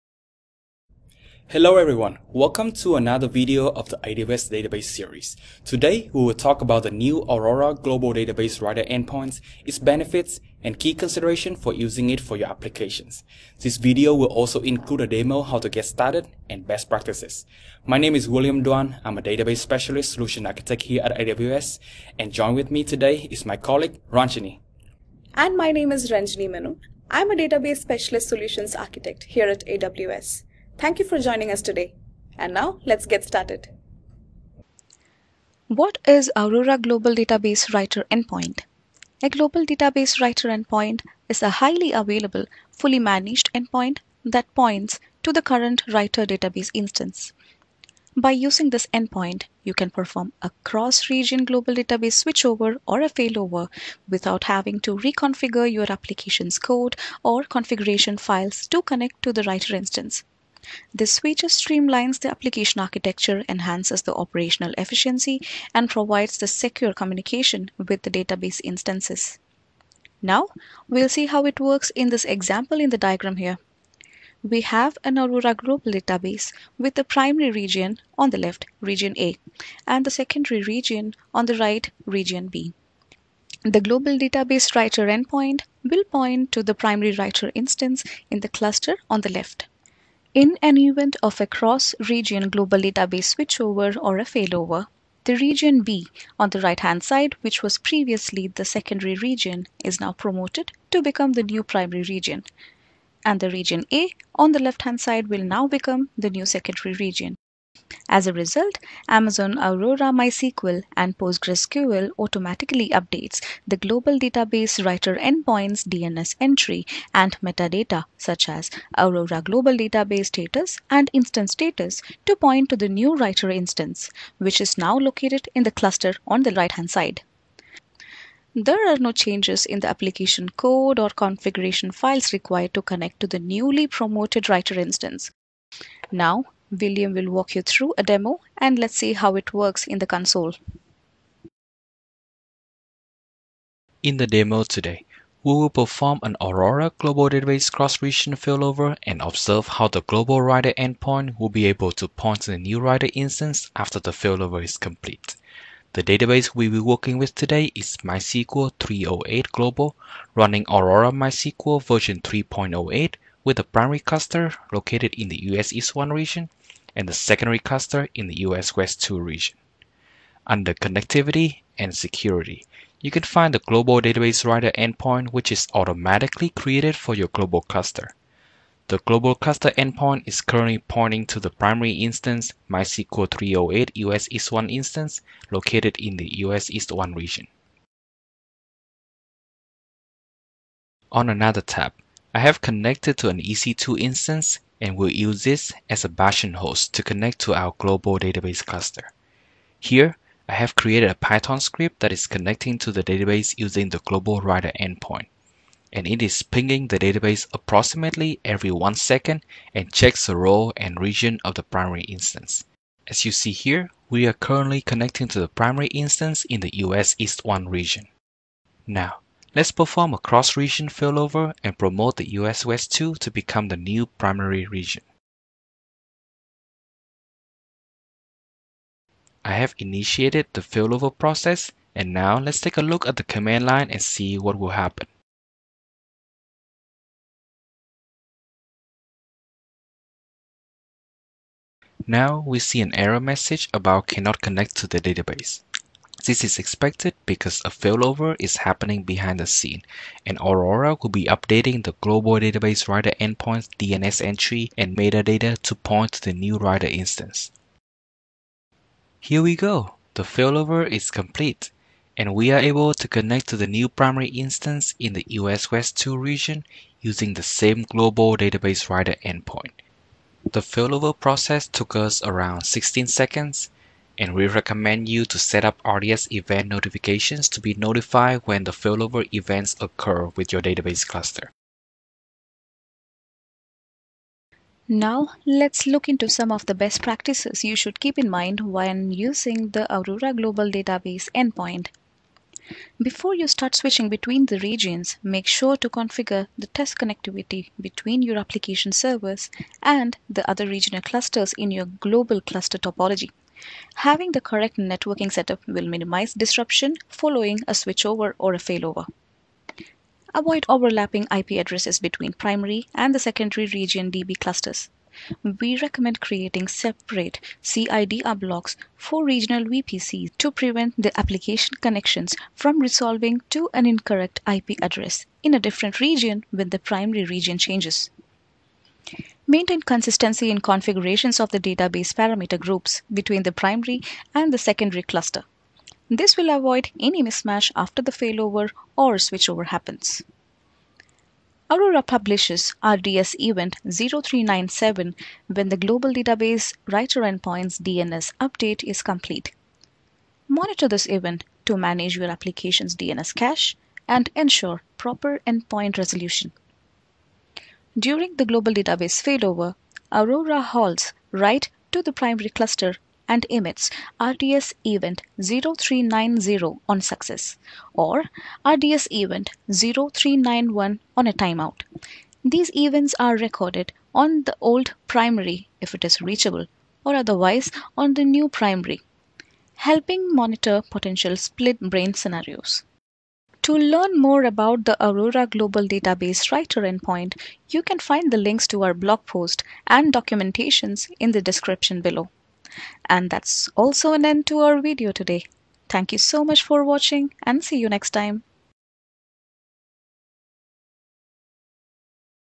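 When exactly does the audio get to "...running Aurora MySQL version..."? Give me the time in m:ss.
2:40.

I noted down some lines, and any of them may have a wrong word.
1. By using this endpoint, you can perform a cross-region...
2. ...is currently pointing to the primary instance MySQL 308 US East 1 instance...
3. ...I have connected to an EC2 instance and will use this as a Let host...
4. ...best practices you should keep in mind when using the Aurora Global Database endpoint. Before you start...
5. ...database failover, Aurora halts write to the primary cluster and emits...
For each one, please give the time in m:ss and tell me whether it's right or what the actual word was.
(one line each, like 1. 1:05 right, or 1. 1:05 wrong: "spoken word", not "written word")
1. 0:48 right
2. 3:00 right
3. 3:12 wrong: "Bastion", not "Let"
4. 4:46 right
5. 5:58 right.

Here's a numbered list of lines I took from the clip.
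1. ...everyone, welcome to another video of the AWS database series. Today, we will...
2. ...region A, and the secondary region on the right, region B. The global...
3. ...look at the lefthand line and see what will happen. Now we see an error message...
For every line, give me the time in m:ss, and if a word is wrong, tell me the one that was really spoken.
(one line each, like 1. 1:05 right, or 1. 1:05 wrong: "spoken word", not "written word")
1. 0:01 right
2. 1:18 right
3. 3:52 wrong: "command", not "lefthand".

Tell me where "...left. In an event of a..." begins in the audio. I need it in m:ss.
1:29.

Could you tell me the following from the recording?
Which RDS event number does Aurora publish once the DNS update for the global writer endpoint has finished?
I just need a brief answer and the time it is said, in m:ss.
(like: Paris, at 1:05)
0397, at 5:43.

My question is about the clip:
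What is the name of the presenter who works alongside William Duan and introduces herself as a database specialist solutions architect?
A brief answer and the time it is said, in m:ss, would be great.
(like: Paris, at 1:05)
Ranjini Menon, at 0:26.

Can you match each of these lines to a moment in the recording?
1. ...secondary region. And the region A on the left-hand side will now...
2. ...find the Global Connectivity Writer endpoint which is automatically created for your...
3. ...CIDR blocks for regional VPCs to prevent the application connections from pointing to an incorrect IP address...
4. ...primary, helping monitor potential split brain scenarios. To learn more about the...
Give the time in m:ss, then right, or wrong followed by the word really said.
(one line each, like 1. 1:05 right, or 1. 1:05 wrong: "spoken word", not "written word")
1. 1:41 wrong: "primary", not "secondary"
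2. 2:53 wrong: "Database", not "Connectivity"
3. 5:17 wrong: "resolving", not "pointing"
4. 6:18 right.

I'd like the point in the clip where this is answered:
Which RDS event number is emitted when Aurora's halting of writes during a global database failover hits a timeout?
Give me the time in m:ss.
6:09.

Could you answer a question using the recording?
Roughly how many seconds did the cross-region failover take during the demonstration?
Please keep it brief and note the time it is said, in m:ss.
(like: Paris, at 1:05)
16 seconds, at 4:32.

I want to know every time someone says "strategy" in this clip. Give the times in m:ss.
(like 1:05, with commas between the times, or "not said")
not said.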